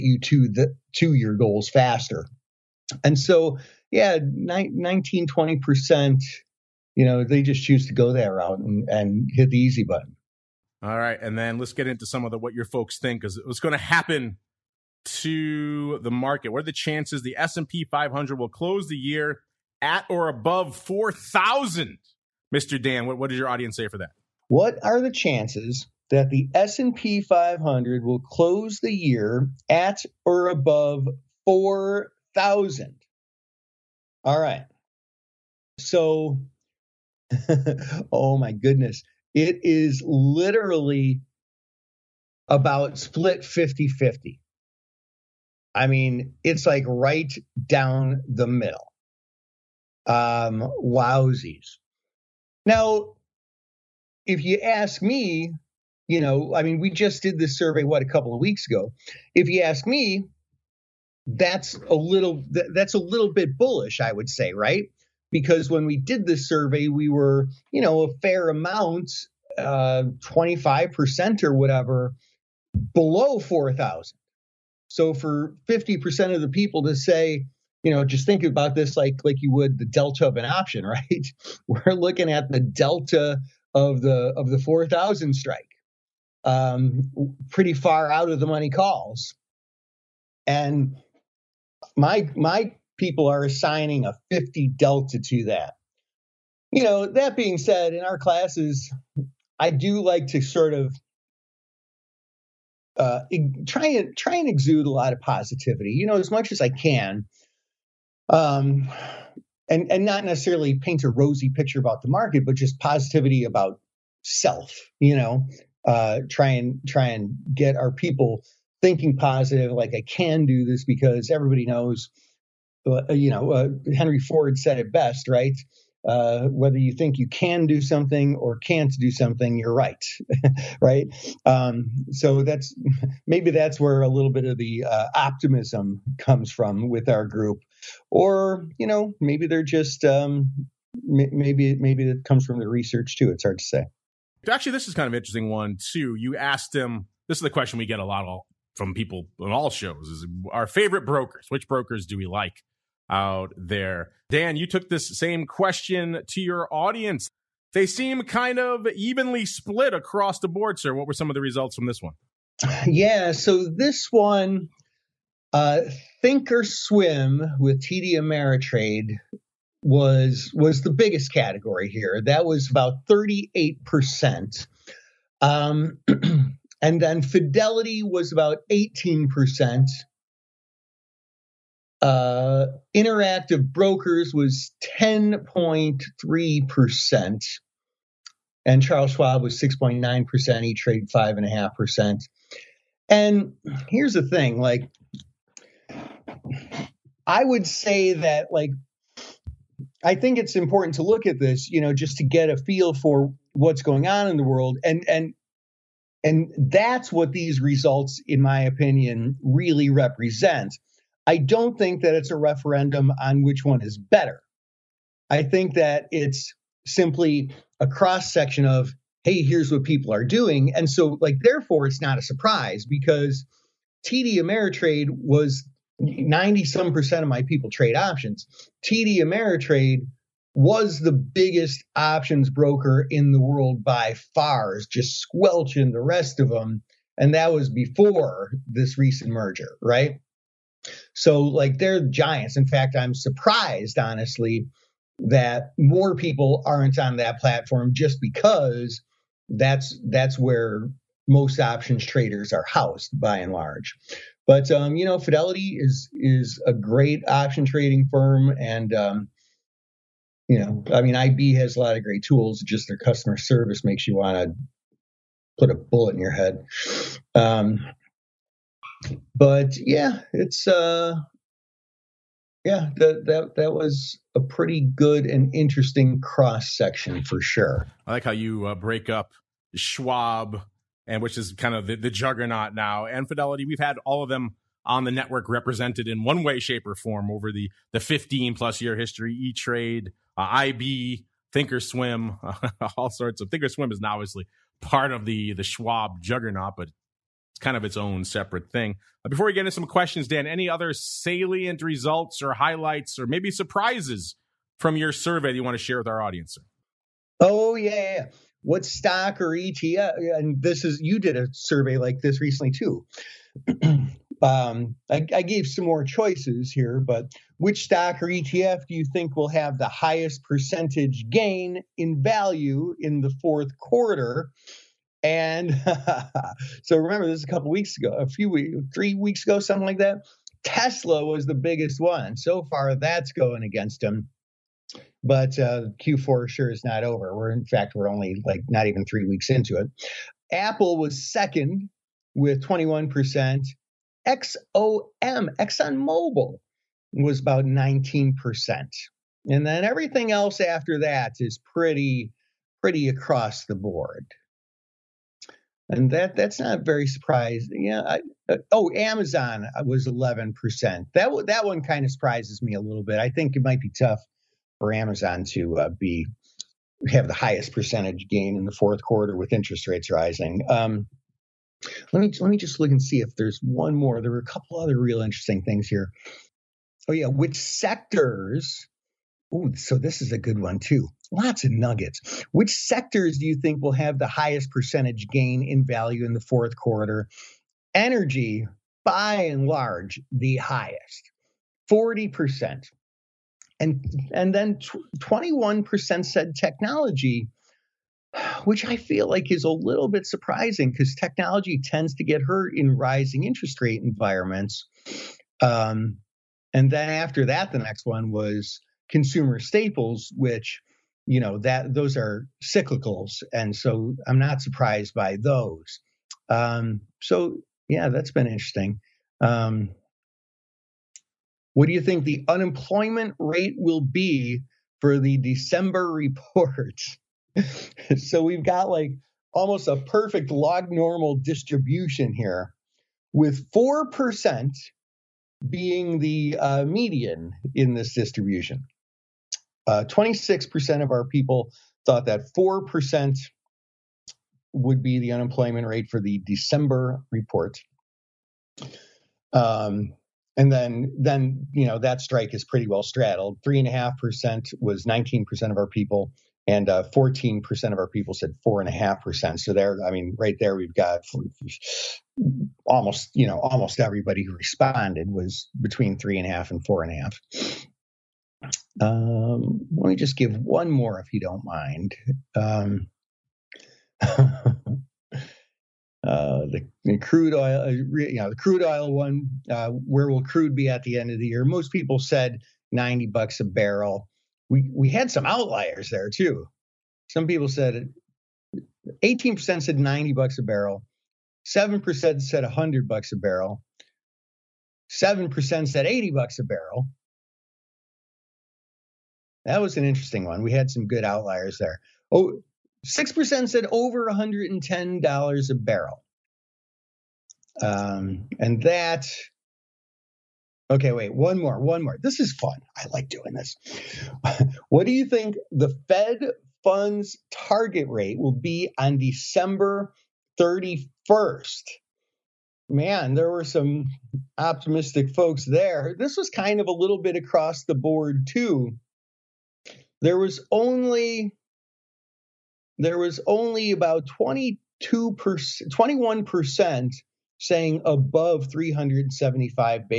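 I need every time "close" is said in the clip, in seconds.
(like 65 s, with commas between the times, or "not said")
18 s, 28 s.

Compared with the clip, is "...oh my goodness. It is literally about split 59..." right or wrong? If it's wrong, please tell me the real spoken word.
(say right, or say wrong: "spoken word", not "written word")
wrong: "50", not "59".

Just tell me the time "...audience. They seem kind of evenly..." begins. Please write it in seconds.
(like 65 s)
156 s.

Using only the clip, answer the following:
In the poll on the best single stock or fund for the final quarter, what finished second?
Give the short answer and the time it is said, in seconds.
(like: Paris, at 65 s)
Apple, at 340 s.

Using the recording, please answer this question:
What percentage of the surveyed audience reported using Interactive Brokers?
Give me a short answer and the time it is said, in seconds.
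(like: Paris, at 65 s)
10.3%, at 184 s.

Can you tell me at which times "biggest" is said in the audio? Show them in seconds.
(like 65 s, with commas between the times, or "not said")
170 s, 231 s, 331 s.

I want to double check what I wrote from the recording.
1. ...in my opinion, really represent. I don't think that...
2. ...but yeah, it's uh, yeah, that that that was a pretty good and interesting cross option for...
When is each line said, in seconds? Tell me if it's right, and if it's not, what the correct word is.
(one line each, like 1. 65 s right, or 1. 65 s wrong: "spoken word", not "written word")
1. 208 s right
2. 269 s wrong: "section", not "option".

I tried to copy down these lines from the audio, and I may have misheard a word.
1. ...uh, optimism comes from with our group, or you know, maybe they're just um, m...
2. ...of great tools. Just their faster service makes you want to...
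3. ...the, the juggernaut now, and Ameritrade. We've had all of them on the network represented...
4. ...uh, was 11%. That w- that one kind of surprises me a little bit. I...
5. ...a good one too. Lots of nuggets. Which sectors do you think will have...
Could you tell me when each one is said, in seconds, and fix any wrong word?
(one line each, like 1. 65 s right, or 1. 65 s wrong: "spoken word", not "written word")
1. 134 s right
2. 261 s wrong: "customer", not "faster"
3. 281 s wrong: "Fidelity", not "Ameritrade"
4. 359 s right
5. 380 s right.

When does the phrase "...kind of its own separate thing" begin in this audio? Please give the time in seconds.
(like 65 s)
297 s.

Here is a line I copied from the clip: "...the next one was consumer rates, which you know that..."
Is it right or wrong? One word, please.
wrong.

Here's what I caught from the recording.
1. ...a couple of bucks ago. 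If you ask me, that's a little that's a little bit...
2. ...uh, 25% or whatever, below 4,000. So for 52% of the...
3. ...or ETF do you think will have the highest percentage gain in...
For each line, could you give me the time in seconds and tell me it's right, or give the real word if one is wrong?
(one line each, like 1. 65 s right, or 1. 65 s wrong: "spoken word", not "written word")
1. 58 s wrong: "weeks", not "bucks"
2. 69 s wrong: "50", not "52"
3. 318 s right.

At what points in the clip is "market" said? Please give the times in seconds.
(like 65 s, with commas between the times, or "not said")
16 s, 112 s.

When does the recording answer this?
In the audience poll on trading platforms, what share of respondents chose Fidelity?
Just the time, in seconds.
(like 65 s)
177 s.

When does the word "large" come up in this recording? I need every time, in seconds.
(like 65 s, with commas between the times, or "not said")
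253 s, 389 s.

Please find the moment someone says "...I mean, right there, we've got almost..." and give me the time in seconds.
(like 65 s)
460 s.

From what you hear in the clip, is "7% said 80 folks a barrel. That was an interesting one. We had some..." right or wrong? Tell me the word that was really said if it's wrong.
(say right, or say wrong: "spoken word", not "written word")
wrong: "bucks", not "folks".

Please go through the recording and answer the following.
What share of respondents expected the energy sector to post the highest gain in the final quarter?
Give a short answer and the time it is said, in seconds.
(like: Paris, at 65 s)
40%, at 391 s.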